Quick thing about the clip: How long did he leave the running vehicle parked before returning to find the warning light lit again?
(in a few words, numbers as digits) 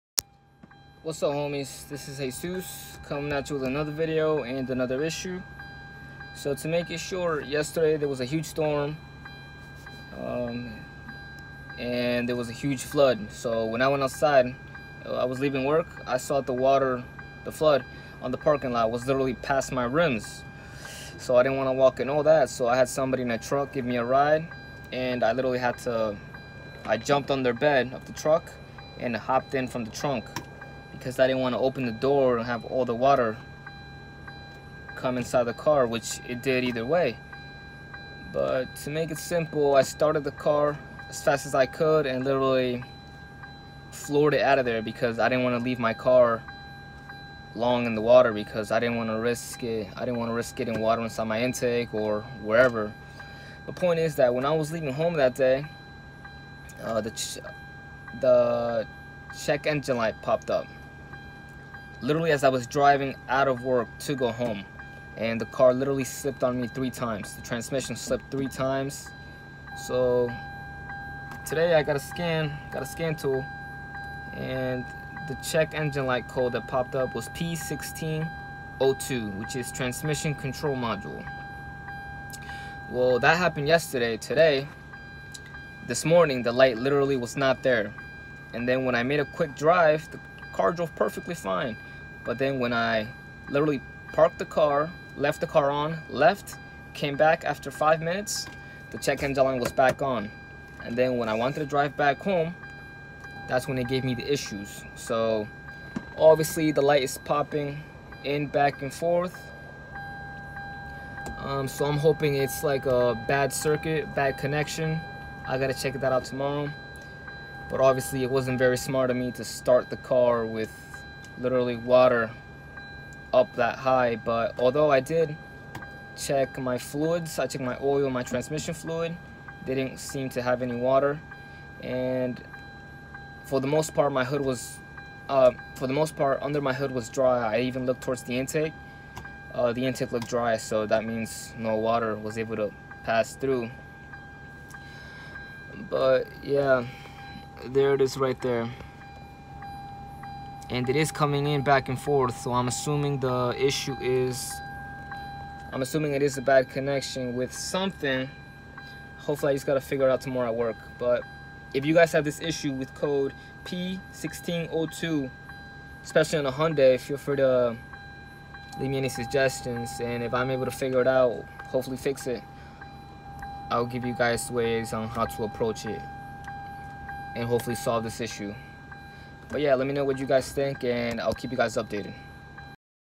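5 minutes.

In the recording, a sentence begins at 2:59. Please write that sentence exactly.
But yeah, let me know what you guys think and I'll keep you guys updated.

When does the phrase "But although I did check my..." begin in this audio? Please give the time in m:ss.
2:04.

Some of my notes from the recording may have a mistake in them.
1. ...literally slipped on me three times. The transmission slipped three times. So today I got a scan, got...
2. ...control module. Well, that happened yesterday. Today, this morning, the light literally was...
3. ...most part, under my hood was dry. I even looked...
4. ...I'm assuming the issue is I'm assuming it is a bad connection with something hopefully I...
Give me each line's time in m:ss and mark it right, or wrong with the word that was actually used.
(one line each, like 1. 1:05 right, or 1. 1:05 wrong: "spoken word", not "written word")
1. 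1:05 right
2. 1:20 right
3. 2:15 right
4. 2:32 right.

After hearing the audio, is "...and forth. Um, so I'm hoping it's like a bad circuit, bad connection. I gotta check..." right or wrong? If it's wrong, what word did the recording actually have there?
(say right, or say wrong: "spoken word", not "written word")
right.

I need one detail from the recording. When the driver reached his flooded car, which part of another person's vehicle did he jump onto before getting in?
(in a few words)
bed of the truck.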